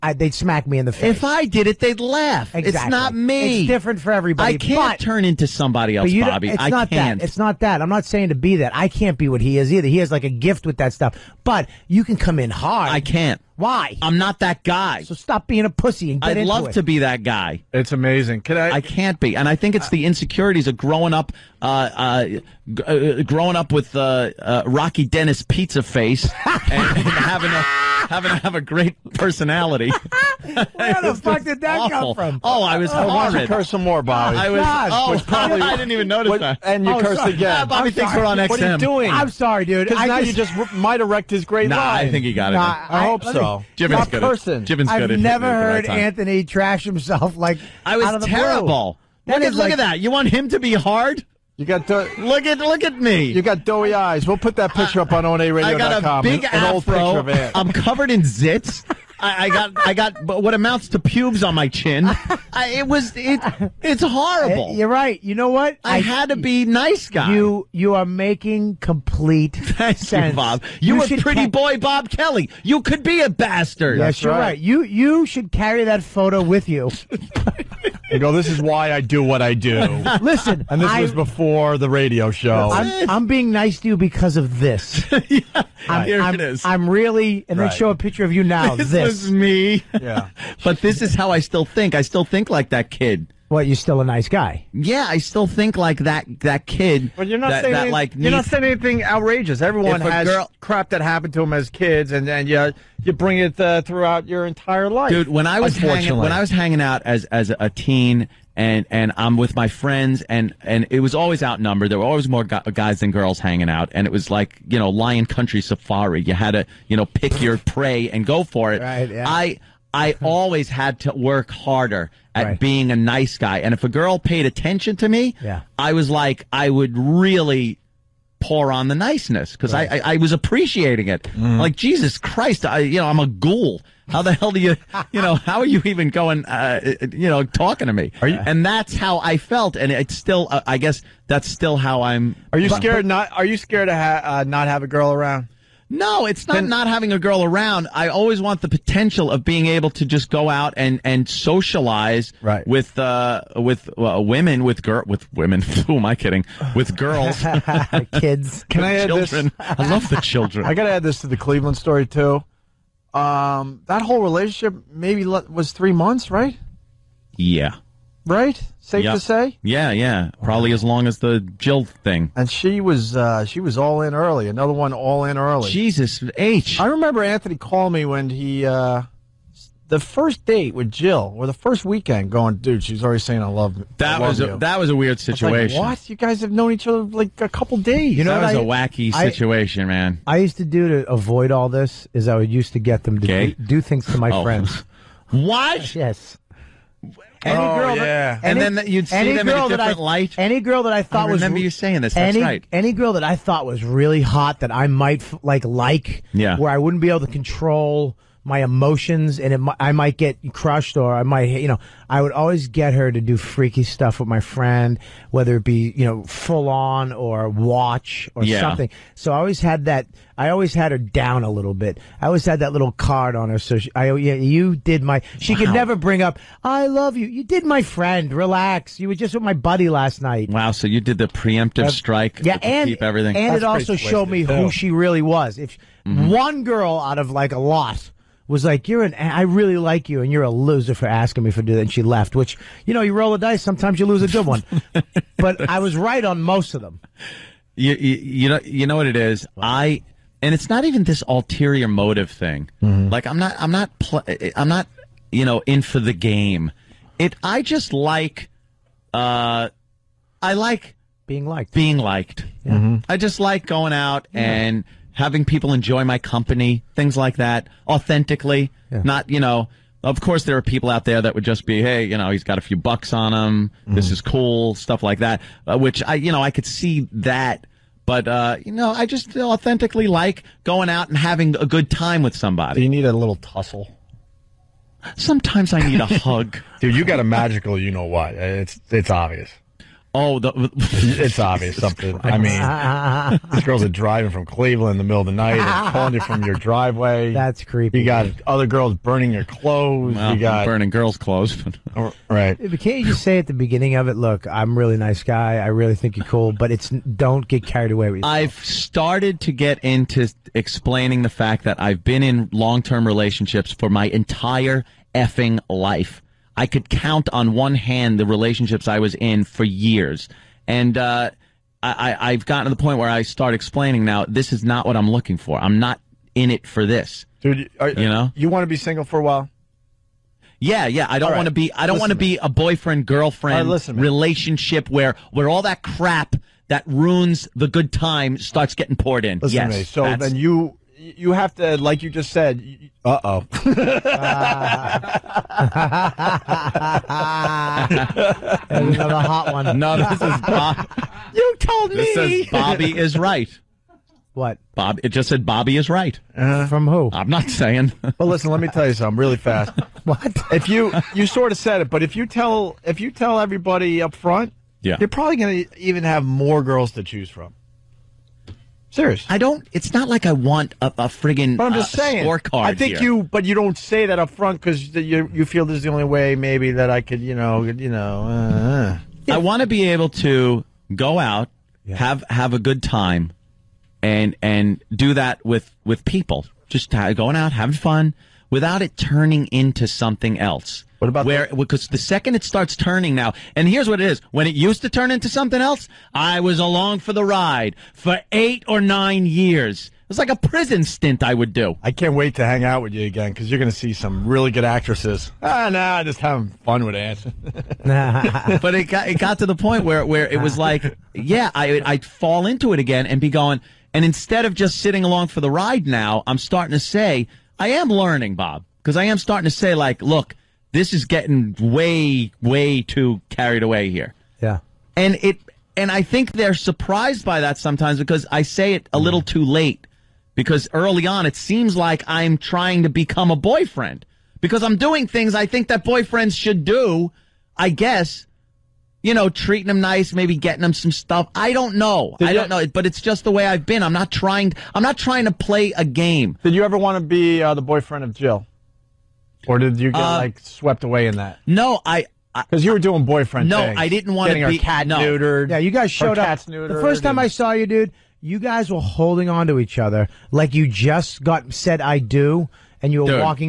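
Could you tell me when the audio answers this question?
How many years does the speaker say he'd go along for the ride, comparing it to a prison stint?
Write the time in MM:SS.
06:38.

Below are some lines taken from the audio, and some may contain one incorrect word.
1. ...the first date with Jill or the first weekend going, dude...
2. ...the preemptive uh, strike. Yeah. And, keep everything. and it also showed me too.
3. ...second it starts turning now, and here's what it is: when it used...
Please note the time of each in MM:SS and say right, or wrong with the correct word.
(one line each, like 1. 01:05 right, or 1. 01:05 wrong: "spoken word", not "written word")
1. 02:59 right
2. 03:51 right
3. 06:31 right.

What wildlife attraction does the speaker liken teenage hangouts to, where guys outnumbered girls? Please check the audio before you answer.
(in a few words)
Lion Country Safari.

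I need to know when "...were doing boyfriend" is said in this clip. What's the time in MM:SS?
07:32.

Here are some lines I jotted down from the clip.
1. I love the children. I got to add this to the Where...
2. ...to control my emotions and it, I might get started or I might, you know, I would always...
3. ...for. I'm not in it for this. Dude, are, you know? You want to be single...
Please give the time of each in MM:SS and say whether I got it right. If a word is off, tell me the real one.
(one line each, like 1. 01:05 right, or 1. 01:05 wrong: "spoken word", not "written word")
1. 02:39 wrong: "Cleveland", not "Where"
2. 03:27 wrong: "crushed", not "started"
3. 05:25 right.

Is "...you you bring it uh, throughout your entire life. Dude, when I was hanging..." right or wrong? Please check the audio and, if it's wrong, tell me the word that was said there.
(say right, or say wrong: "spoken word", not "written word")
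right.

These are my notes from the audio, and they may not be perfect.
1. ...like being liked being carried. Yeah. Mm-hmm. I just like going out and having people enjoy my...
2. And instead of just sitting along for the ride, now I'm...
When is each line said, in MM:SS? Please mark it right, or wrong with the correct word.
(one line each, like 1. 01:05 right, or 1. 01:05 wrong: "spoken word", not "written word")
1. 04:20 wrong: "liked", not "carried"
2. 06:53 right.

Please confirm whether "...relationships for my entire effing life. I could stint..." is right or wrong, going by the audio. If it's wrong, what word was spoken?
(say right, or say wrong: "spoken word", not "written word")
wrong: "count", not "stint".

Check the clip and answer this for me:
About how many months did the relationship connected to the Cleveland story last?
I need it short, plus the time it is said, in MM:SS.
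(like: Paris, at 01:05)
3, at 02:45.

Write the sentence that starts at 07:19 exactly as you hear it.
You know, treating them nice, maybe getting them some stuff.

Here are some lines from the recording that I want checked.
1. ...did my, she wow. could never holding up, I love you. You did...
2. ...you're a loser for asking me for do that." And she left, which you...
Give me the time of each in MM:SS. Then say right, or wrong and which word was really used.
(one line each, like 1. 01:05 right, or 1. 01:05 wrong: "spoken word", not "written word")
1. 03:44 wrong: "bring", not "holding"
2. 04:00 right.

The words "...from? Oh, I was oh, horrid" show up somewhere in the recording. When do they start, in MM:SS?
00:32.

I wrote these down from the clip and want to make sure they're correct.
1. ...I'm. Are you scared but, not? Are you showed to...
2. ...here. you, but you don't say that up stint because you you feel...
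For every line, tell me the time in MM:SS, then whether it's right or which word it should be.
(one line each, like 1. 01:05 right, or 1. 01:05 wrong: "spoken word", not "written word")
1. 02:22 wrong: "scared", not "showed"
2. 06:12 wrong: "front", not "stint".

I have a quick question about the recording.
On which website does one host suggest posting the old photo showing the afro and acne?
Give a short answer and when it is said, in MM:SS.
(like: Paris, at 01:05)
onaradio.com, at 00:55.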